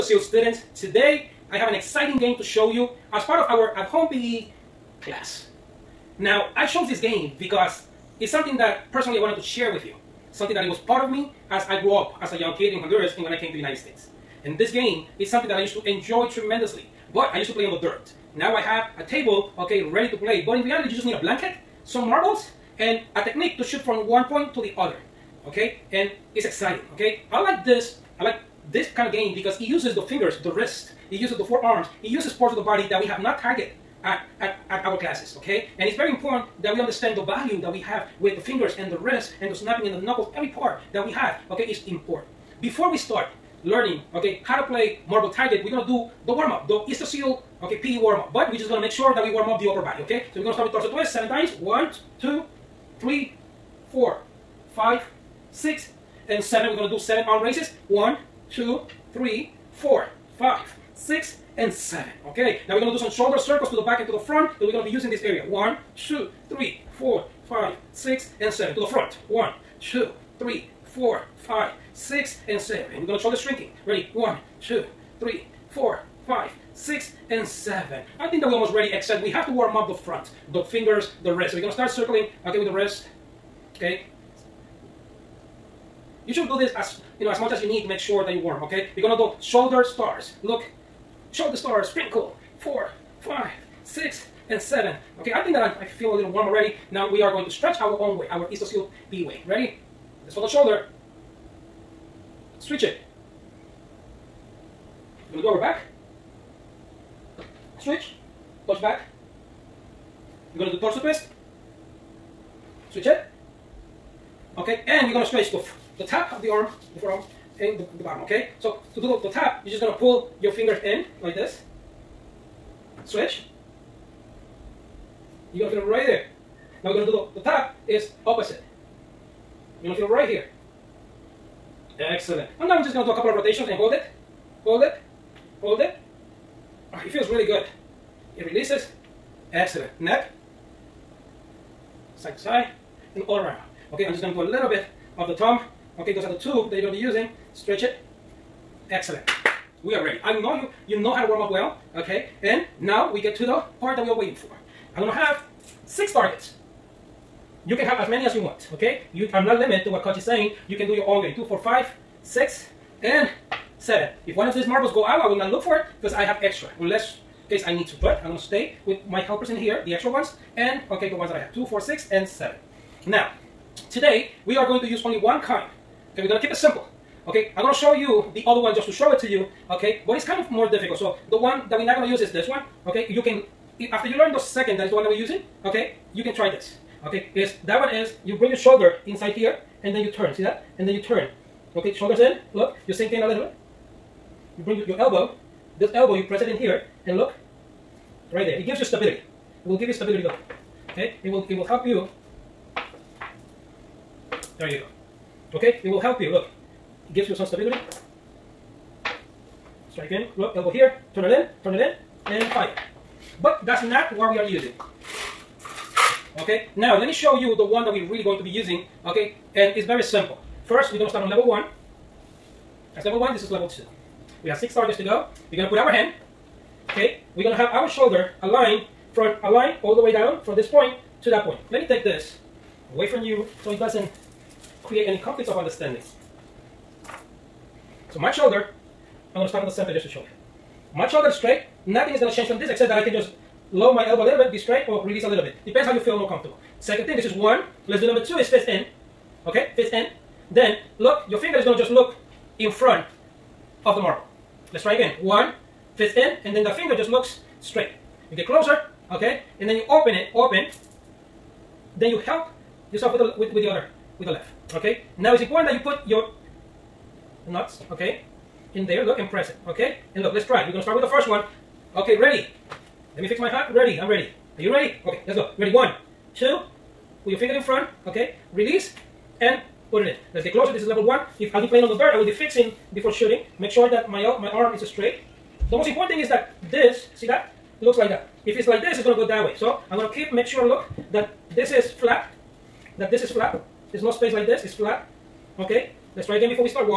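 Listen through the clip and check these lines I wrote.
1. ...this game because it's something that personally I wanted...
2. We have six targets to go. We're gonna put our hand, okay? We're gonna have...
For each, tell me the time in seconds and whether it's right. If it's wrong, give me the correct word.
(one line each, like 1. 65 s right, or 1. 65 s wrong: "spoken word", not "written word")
1. 6 s right
2. 224 s right.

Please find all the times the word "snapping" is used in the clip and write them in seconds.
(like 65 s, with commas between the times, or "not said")
39 s.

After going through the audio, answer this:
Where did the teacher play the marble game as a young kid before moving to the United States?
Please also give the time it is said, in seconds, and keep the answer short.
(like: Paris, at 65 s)
Honduras, at 12 s.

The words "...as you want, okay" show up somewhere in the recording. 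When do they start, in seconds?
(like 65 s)
158 s.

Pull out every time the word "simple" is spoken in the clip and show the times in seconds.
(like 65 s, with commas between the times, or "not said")
176 s, 220 s.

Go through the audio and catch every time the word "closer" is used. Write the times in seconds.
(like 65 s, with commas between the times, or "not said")
258 s, 280 s.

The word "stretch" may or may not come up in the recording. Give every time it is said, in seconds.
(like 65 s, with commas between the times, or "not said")
97 s, 115 s, 147 s.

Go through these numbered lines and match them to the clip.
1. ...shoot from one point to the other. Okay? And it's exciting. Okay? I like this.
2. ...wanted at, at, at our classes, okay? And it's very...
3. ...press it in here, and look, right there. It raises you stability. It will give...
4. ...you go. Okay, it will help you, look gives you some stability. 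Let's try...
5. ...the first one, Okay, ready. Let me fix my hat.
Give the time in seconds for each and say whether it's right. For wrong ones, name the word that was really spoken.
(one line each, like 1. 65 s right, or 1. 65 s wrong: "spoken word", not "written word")
1. 23 s right
2. 33 s wrong: "targeted", not "wanted"
3. 196 s wrong: "gives", not "raises"
4. 204 s right
5. 271 s right.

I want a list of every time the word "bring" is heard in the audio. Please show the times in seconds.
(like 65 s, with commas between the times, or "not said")
188 s, 194 s.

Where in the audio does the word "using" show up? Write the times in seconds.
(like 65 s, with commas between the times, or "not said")
64 s, 146 s, 185 s, 214 s, 218 s.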